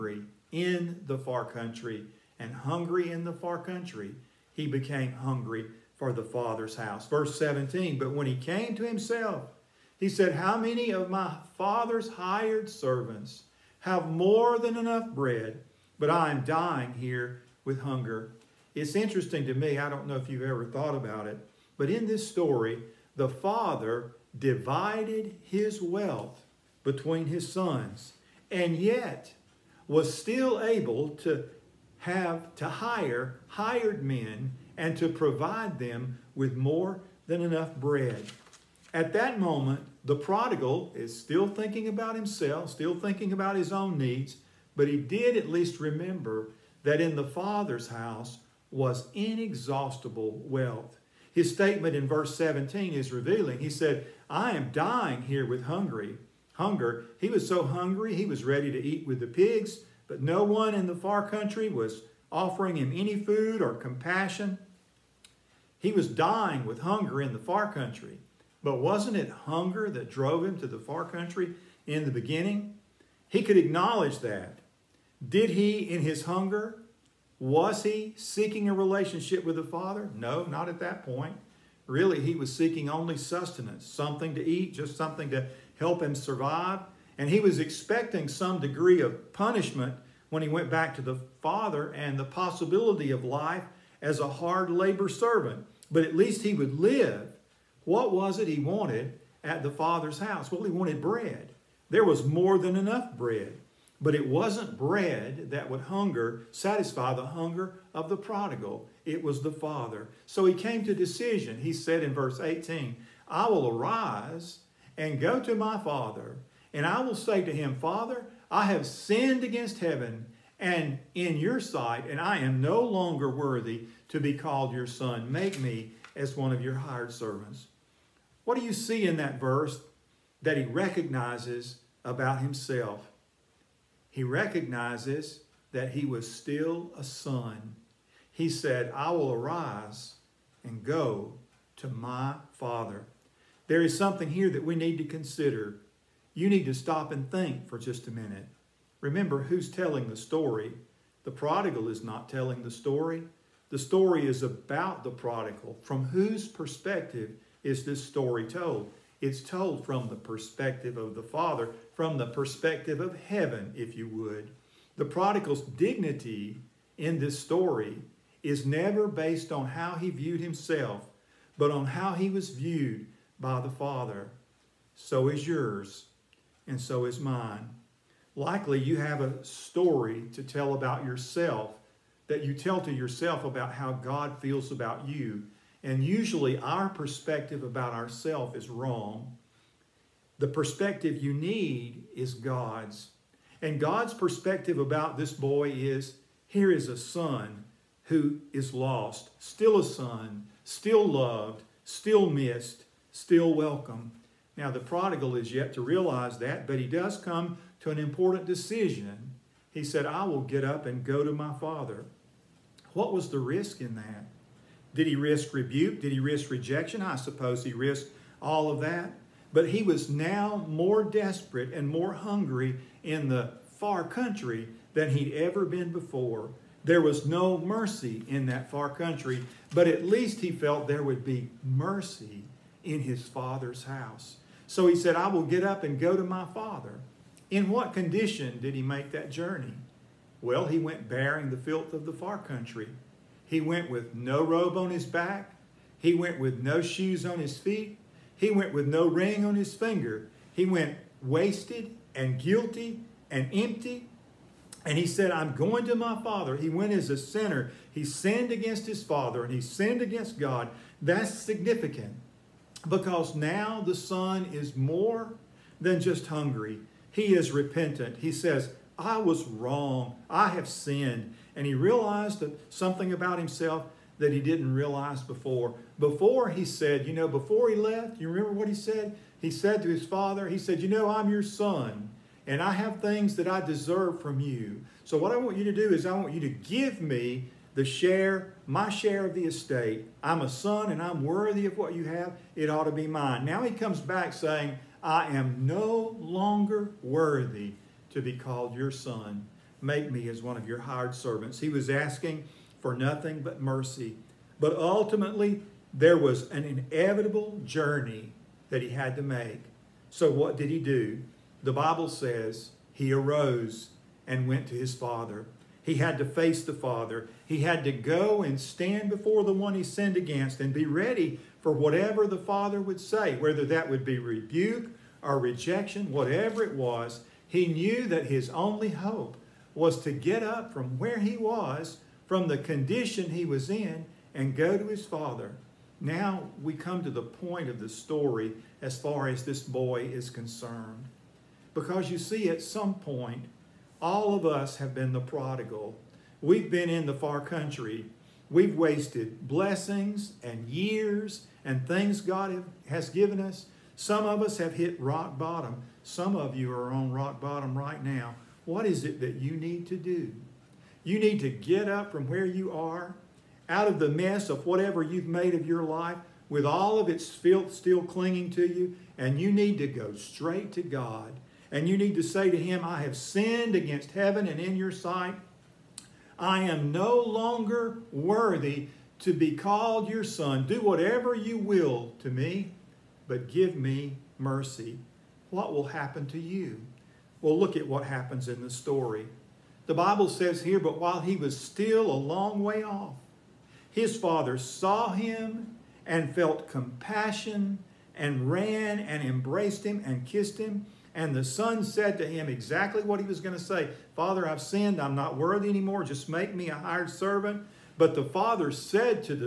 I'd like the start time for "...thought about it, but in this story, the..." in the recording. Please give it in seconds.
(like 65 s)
20 s.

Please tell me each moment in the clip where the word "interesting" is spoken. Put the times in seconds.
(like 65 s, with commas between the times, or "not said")
18 s.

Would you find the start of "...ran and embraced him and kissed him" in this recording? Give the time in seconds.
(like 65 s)
398 s.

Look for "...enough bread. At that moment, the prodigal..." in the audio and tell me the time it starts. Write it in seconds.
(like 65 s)
37 s.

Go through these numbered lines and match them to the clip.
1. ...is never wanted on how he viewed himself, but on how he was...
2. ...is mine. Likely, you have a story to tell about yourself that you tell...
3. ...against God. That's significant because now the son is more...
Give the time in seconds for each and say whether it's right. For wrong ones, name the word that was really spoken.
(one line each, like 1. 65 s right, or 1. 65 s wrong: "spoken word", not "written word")
1. 168 s wrong: "based", not "wanted"
2. 177 s right
3. 260 s right.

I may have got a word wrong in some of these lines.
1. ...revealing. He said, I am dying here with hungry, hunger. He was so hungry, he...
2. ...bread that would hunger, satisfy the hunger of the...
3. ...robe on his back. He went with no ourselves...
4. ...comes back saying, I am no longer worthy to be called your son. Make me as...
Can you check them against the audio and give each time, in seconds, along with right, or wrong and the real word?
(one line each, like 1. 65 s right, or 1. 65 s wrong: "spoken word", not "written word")
1. 53 s right
2. 104 s right
3. 244 s wrong: "shoes", not "ourselves"
4. 293 s right.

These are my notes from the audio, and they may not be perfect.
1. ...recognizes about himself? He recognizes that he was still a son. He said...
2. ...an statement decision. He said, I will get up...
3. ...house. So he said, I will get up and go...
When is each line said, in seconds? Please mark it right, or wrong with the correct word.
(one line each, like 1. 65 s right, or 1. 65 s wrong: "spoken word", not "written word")
1. 130 s right
2. 207 s wrong: "important", not "statement"
3. 233 s right.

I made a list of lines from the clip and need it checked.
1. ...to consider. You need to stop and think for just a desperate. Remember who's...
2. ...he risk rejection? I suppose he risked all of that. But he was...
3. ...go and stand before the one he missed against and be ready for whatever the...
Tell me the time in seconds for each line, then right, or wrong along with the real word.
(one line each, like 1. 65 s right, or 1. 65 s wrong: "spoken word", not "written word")
1. 144 s wrong: "minute", not "desperate"
2. 216 s right
3. 317 s wrong: "sinned", not "missed".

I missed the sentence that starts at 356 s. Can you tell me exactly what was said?
Some of you are on rock bottom right now.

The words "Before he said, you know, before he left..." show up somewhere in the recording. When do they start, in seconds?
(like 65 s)
275 s.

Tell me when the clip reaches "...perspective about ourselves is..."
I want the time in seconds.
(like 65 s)
186 s.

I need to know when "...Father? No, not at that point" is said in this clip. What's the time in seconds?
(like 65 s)
79 s.